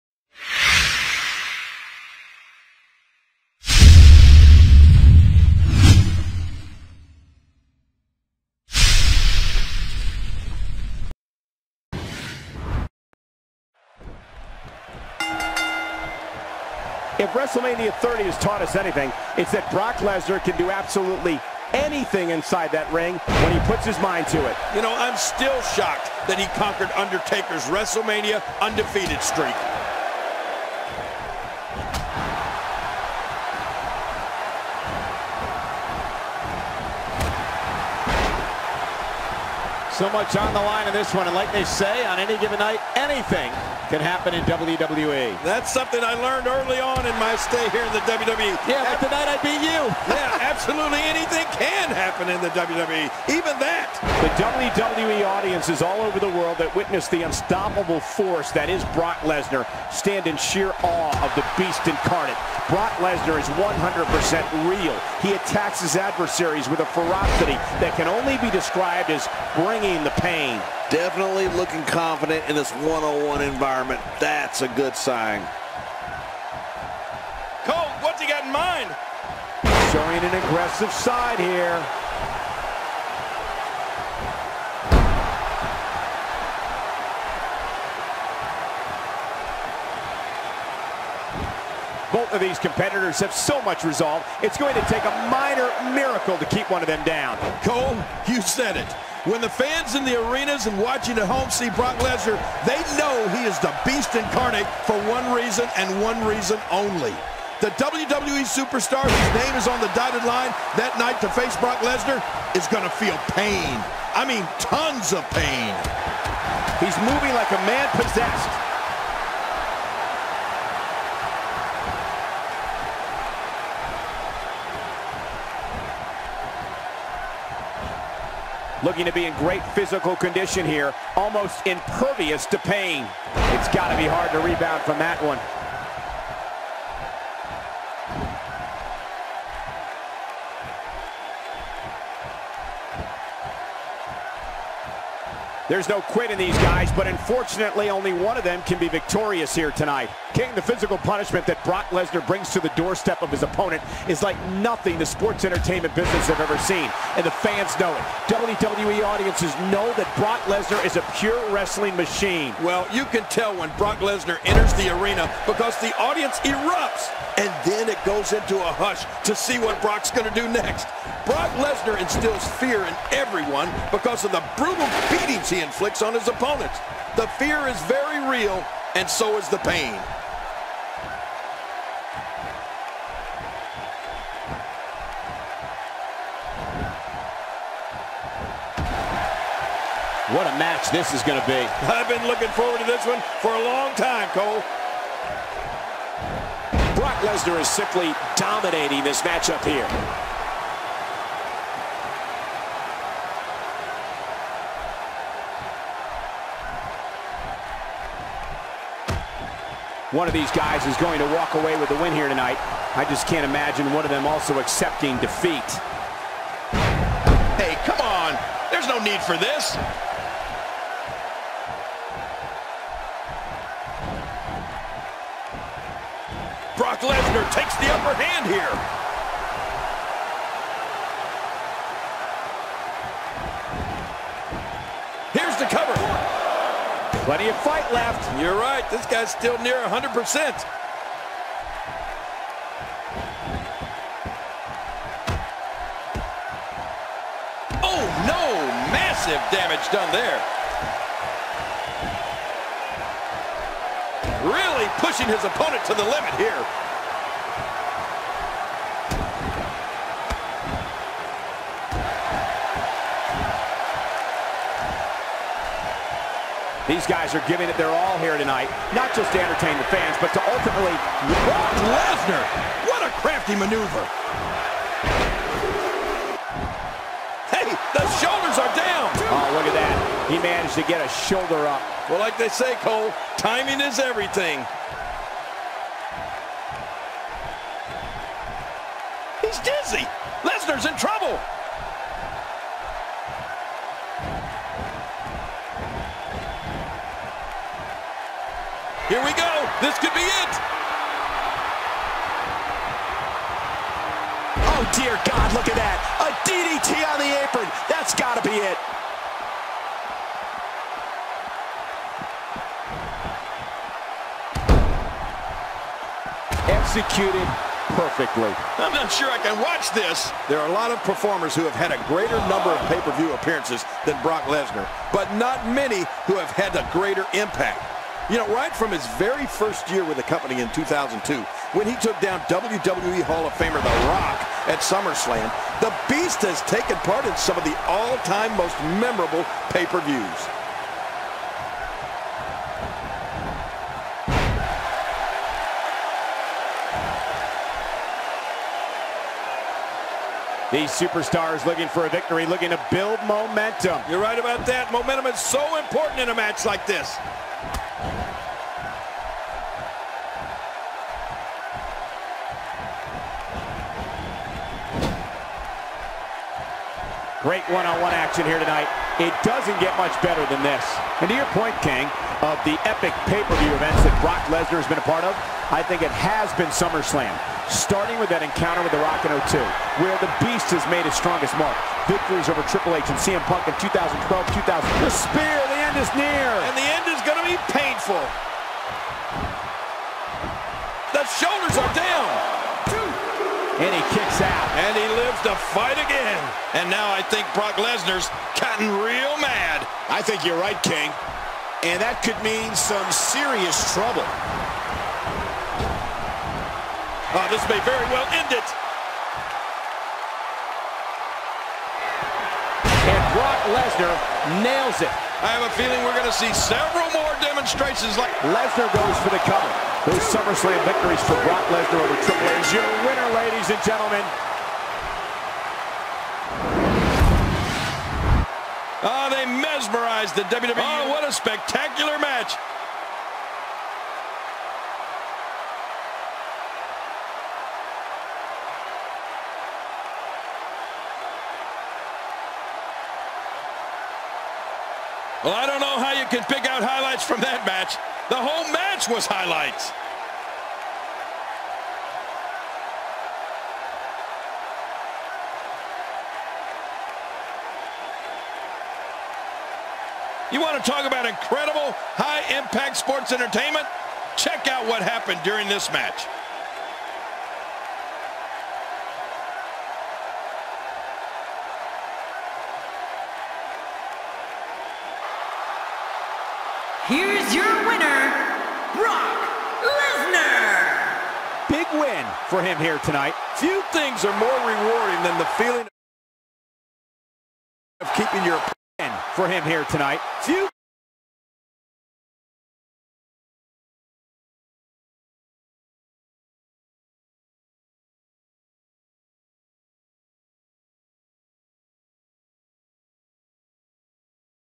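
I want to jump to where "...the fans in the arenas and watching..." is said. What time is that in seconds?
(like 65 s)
99 s.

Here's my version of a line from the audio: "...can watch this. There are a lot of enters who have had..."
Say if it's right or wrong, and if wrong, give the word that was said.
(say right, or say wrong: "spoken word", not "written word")
wrong: "performers", not "enters".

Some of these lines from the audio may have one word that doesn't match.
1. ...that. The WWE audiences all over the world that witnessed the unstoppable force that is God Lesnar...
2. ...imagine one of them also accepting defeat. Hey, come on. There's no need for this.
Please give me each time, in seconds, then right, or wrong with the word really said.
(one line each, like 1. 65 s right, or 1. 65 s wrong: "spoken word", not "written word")
1. 53 s wrong: "Brock", not "God"
2. 213 s right.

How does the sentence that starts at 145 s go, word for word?
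There's no quit in these guys, but unfortunately only one of them can be victorious here tonight.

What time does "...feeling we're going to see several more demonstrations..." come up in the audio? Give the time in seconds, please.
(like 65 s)
415 s.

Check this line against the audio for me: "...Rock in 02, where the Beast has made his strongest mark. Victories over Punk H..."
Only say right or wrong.
wrong.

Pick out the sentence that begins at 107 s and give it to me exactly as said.
The WWE superstar whose name is on the dotted line that night to face Brock Lesnar is going to feel pain.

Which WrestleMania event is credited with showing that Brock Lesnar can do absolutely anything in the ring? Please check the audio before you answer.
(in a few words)
WrestleMania 30.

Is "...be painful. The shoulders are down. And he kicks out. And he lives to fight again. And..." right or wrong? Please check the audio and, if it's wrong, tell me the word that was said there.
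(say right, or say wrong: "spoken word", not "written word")
right.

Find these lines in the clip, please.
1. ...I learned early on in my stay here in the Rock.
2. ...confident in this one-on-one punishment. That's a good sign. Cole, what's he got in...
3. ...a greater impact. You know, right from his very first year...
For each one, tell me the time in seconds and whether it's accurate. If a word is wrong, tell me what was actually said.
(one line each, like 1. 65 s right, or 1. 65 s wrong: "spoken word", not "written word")
1. 46 s wrong: "WWE", not "Rock"
2. 71 s wrong: "environment", not "punishment"
3. 326 s right.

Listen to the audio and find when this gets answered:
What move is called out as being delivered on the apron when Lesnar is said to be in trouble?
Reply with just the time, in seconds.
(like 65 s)
306 s.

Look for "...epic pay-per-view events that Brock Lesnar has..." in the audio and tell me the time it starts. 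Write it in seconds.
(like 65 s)
372 s.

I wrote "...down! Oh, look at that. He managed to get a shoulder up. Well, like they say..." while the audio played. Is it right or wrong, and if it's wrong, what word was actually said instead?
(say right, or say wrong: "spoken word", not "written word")
right.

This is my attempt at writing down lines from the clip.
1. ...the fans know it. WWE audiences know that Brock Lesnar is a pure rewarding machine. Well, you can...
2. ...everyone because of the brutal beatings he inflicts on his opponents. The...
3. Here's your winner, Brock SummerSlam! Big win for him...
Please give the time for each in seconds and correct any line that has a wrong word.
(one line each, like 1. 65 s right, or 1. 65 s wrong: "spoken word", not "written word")
1. 157 s wrong: "wrestling", not "rewarding"
2. 173 s right
3. 477 s wrong: "Lesnar", not "SummerSlam".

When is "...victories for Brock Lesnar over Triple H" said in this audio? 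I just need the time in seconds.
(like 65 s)
420 s.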